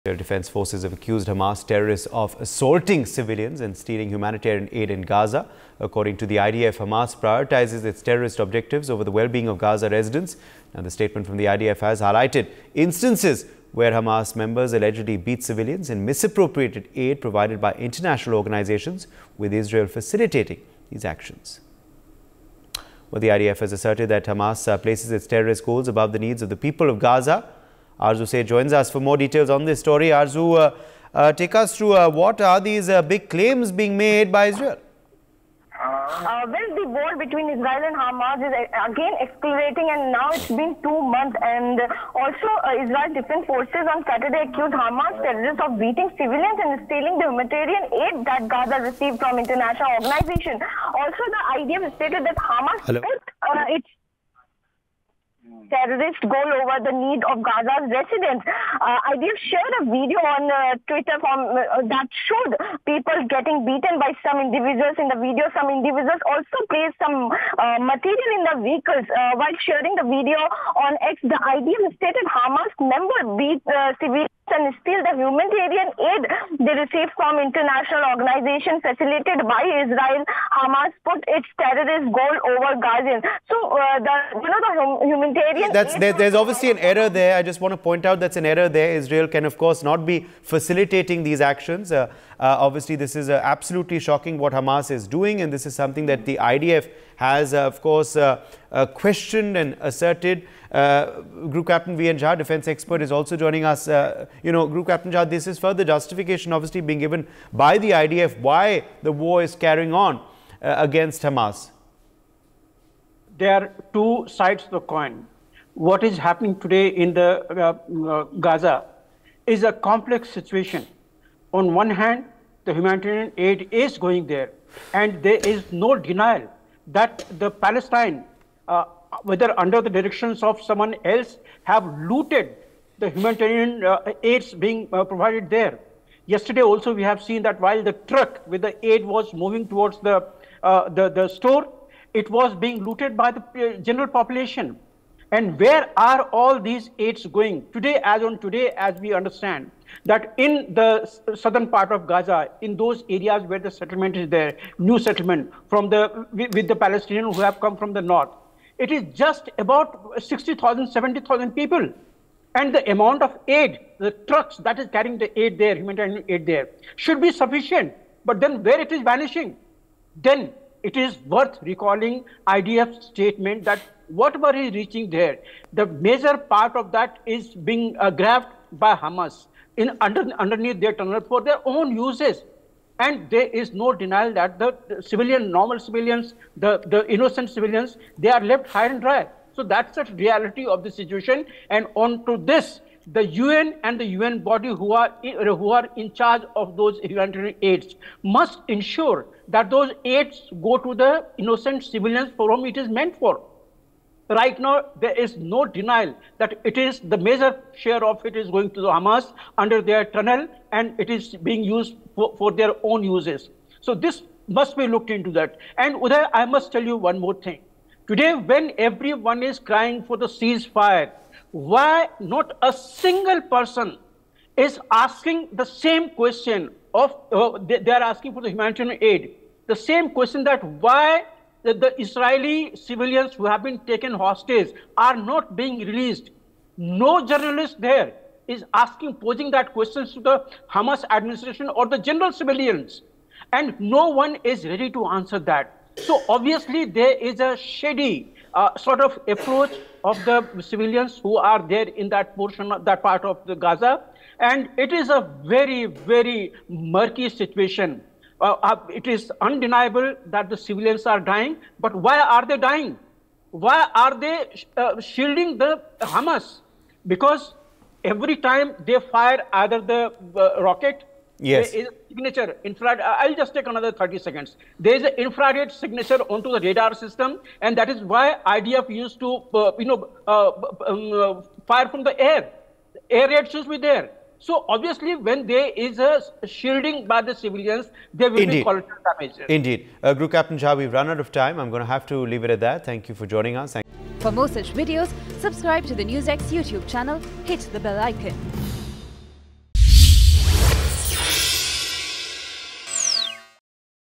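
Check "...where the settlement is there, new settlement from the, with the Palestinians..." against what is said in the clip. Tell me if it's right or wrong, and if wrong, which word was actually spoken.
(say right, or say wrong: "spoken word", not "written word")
right.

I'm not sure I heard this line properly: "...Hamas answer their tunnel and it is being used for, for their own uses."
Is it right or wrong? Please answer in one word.
wrong.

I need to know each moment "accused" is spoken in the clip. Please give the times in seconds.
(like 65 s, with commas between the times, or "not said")
0 s, 44 s.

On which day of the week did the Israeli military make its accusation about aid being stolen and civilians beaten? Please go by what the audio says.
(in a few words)
Saturday.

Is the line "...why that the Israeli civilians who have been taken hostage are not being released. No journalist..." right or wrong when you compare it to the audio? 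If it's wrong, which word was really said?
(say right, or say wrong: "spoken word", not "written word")
right.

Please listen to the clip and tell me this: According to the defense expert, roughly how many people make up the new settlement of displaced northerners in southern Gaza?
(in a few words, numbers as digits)
60,000 to 70,000.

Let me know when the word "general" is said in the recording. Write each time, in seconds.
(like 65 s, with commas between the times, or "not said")
143 s, 241 s.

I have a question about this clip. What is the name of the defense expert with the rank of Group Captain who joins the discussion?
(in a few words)
V. N. Jha.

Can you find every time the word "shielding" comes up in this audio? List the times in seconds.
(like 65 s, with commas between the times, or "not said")
264 s, 286 s.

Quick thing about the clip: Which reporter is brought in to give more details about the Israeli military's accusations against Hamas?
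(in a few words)
Arzu Say.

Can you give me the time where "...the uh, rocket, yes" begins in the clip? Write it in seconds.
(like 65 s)
269 s.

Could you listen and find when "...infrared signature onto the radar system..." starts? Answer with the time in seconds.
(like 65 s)
275 s.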